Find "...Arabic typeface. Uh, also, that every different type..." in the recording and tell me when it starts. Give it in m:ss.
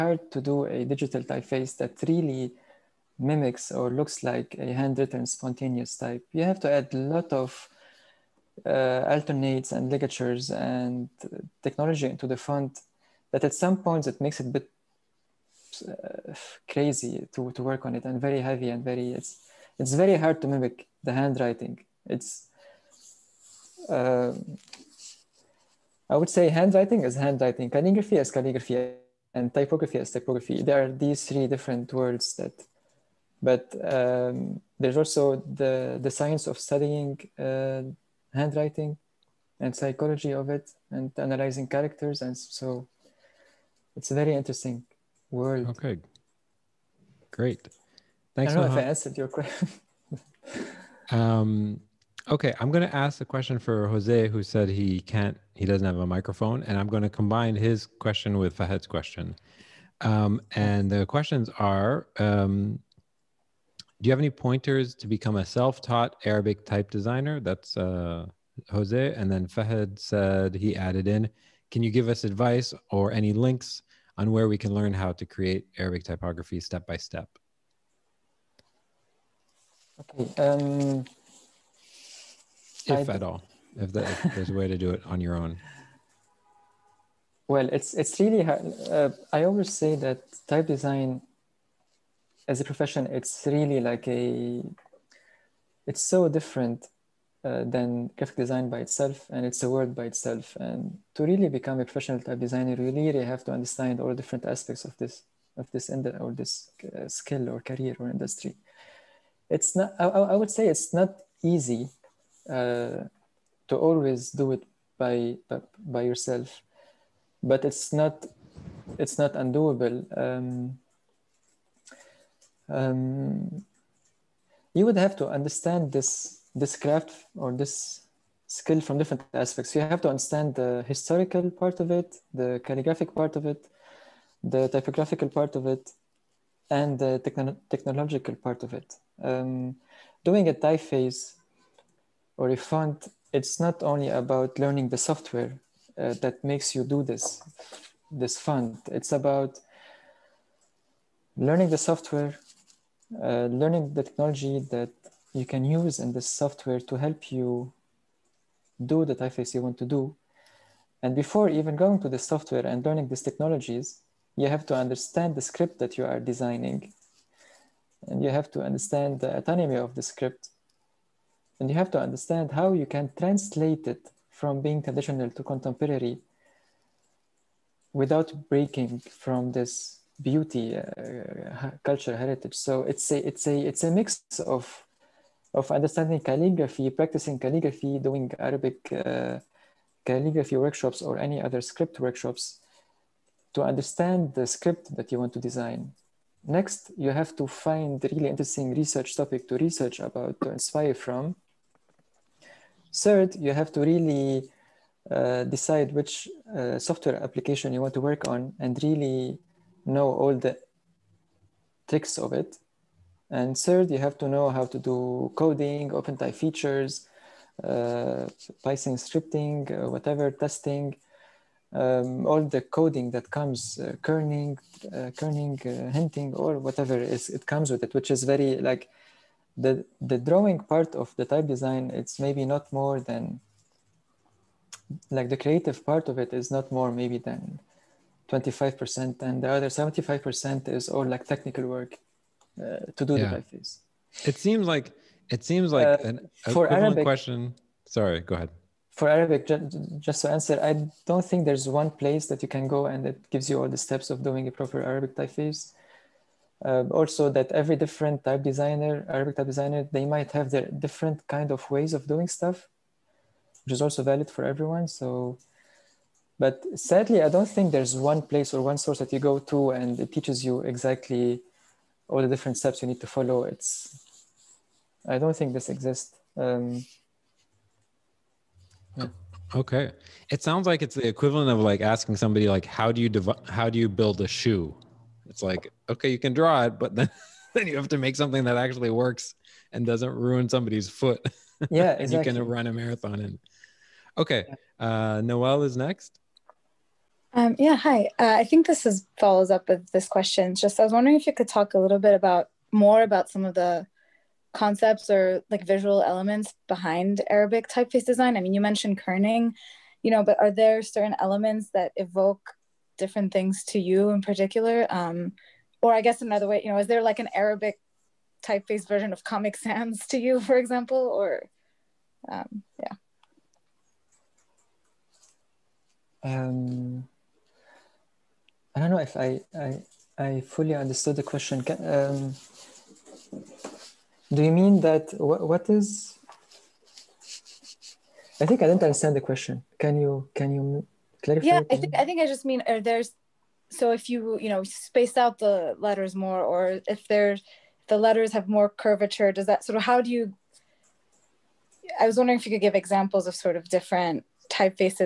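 4:14.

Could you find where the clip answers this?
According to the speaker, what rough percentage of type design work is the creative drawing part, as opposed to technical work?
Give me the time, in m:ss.
3:58.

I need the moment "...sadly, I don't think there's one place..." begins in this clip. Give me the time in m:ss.
4:26.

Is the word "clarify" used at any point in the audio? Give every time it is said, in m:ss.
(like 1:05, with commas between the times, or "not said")
5:41.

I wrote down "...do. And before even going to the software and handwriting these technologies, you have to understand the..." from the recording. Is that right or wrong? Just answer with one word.
wrong.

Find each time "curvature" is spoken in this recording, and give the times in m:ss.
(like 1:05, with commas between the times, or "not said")
5:48.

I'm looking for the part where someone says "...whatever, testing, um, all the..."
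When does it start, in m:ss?
3:39.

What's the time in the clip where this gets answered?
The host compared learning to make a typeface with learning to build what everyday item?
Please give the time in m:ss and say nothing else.
4:44.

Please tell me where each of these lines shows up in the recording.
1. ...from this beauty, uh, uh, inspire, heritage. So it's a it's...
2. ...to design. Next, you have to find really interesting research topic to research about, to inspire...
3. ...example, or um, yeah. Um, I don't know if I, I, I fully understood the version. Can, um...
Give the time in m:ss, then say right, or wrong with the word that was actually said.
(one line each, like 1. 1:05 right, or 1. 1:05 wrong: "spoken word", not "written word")
1. 2:58 wrong: "culture", not "inspire"
2. 3:15 right
3. 5:20 wrong: "question", not "version".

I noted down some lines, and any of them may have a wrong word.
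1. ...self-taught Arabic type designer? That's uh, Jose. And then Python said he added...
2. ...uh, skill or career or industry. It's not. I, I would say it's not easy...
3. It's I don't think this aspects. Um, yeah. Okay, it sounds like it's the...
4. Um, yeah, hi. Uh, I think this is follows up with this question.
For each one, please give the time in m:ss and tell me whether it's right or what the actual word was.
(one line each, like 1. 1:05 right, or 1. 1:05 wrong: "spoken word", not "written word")
1. 1:05 wrong: "Fahad", not "Python"
2. 1:46 right
3. 4:33 wrong: "exists", not "aspects"
4. 4:57 right.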